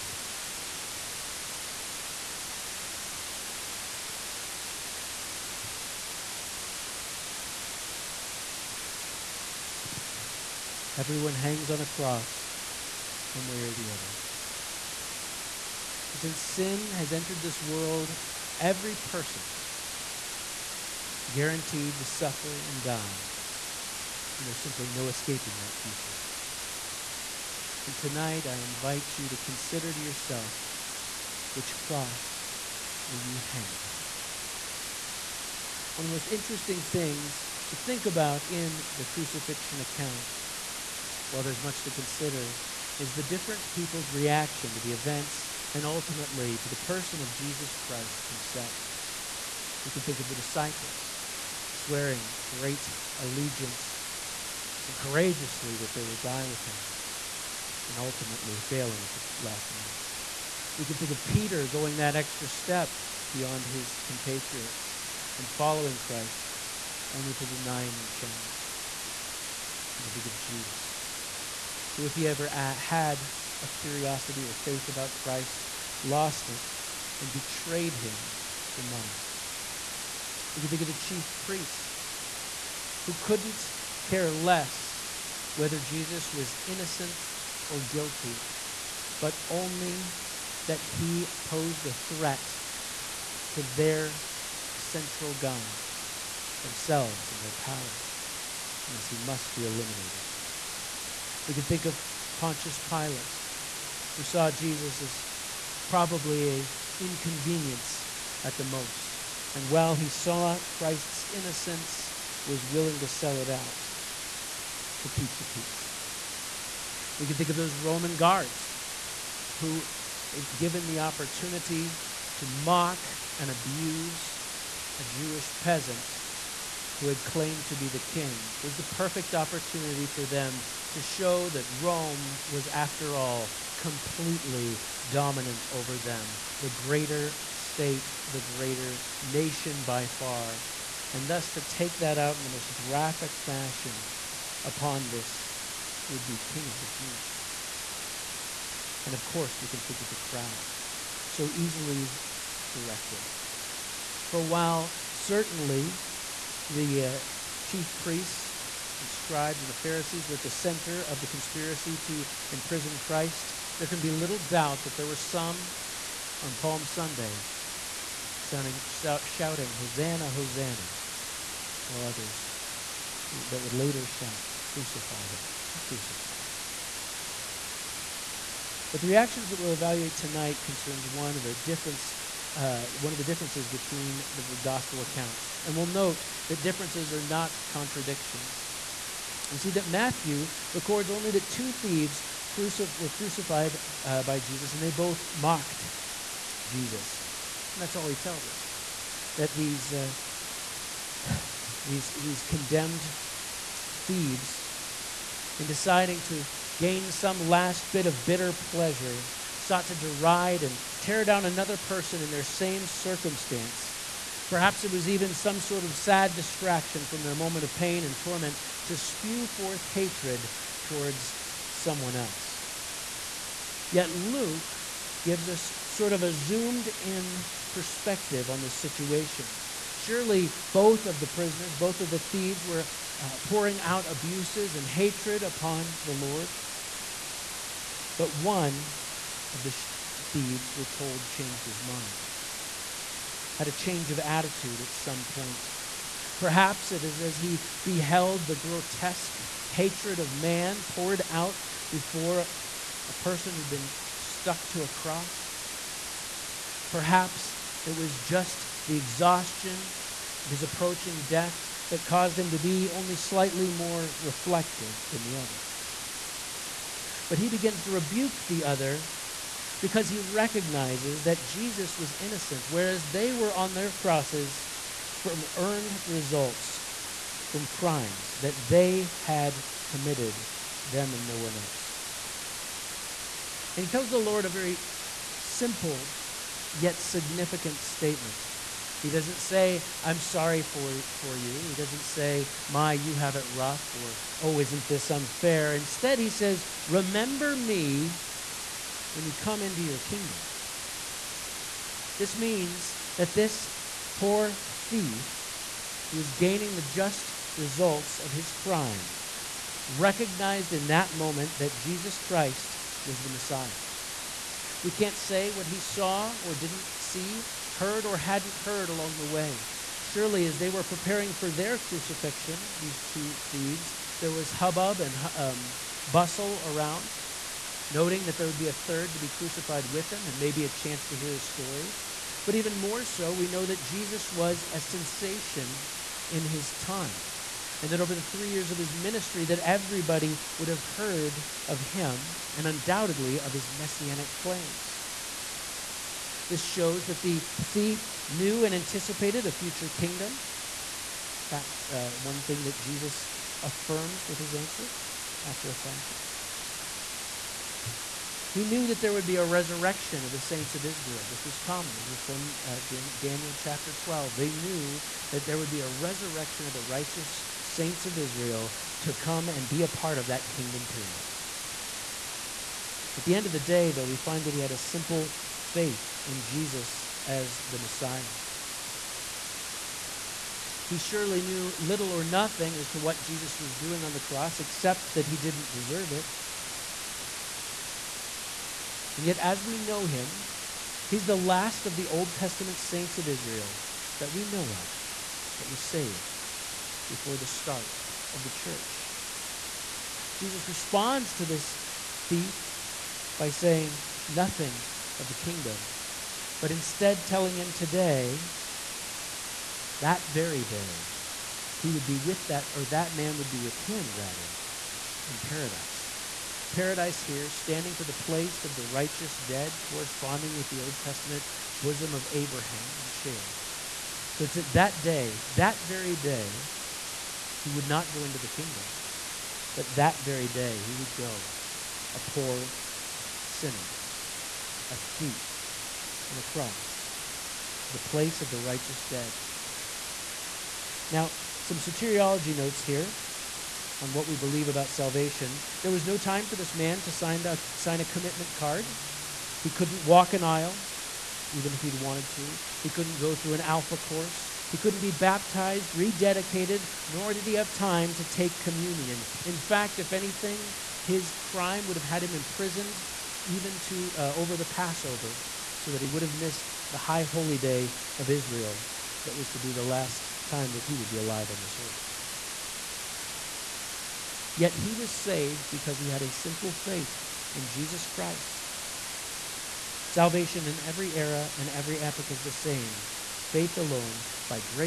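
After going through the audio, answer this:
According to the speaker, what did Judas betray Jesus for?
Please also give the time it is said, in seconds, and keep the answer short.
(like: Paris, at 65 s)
Money, at 78 s.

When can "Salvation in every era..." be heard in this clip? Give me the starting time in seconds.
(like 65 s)
480 s.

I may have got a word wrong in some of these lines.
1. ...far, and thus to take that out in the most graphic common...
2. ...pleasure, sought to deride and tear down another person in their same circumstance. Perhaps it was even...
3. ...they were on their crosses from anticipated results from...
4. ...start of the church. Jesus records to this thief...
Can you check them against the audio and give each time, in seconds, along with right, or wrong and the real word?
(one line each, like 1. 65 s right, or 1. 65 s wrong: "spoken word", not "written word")
1. 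140 s wrong: "fashion", not "common"
2. 208 s right
3. 273 s wrong: "earned", not "anticipated"
4. 397 s wrong: "responds", not "records".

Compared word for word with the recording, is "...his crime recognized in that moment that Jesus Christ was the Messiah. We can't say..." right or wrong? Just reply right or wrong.
right.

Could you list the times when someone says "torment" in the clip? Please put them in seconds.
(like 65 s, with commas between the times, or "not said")
218 s.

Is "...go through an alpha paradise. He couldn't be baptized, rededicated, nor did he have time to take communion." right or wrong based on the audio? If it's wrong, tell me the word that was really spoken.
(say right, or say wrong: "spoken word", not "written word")
wrong: "course", not "paradise".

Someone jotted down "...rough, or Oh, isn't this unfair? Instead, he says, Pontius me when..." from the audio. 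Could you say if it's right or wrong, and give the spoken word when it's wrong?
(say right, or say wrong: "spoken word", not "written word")
wrong: "Remember", not "Pontius".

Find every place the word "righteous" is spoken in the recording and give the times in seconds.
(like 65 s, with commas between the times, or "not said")
366 s, 418 s, 438 s.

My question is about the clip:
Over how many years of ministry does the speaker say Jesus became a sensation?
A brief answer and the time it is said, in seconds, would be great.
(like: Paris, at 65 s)
3, at 338 s.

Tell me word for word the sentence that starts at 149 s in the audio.
And of course, we can think of the crowd, so easily directed.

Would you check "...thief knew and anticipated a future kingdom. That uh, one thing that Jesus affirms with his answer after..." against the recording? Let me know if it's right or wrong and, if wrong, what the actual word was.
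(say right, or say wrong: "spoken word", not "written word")
right.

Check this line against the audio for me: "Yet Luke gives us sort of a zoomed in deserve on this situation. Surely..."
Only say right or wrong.
wrong.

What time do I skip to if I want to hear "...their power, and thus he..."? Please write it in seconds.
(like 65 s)
97 s.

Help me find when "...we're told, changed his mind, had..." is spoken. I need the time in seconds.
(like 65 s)
240 s.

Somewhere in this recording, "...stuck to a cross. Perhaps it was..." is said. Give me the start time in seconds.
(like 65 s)
254 s.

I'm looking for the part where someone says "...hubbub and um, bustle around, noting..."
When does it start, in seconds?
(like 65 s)
324 s.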